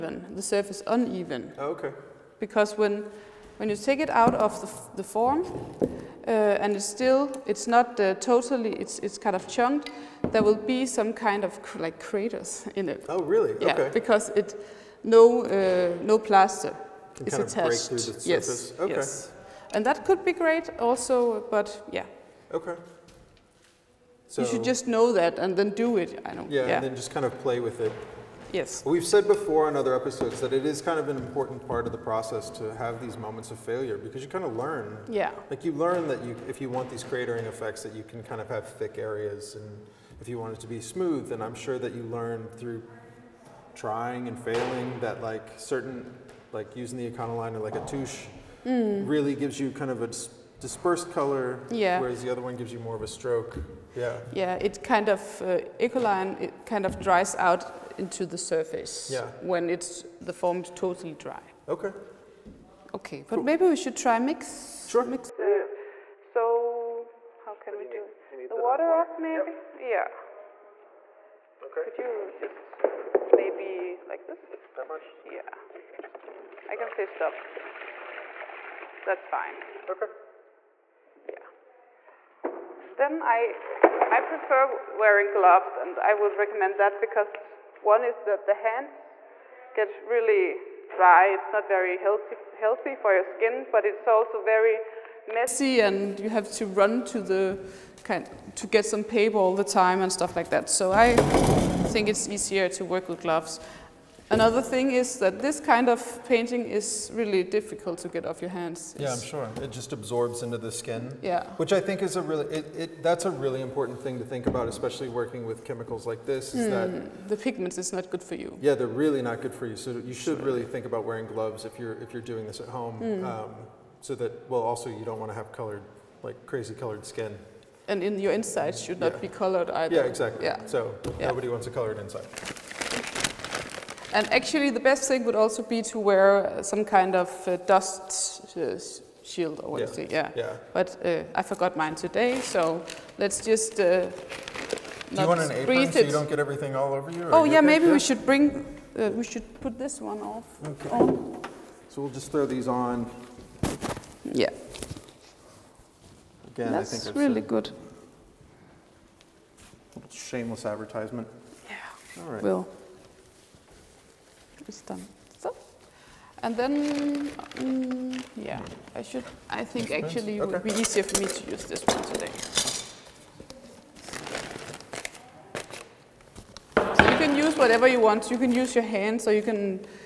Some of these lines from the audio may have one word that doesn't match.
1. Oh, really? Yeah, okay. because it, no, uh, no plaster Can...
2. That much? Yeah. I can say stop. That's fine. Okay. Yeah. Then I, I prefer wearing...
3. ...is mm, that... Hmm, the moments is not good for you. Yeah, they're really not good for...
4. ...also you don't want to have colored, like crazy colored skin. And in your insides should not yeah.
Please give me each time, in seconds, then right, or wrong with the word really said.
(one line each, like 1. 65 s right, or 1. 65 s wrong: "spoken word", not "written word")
1. 13 s right
2. 74 s right
3. 116 s wrong: "pigments", not "moments"
4. 124 s right.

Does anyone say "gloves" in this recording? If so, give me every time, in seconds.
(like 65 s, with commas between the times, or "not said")
85 s, 103 s, 121 s.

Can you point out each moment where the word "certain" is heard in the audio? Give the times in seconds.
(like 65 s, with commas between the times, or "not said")
45 s.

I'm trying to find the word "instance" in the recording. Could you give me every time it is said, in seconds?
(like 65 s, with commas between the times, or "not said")
not said.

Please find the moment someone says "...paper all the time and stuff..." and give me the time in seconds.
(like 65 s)
99 s.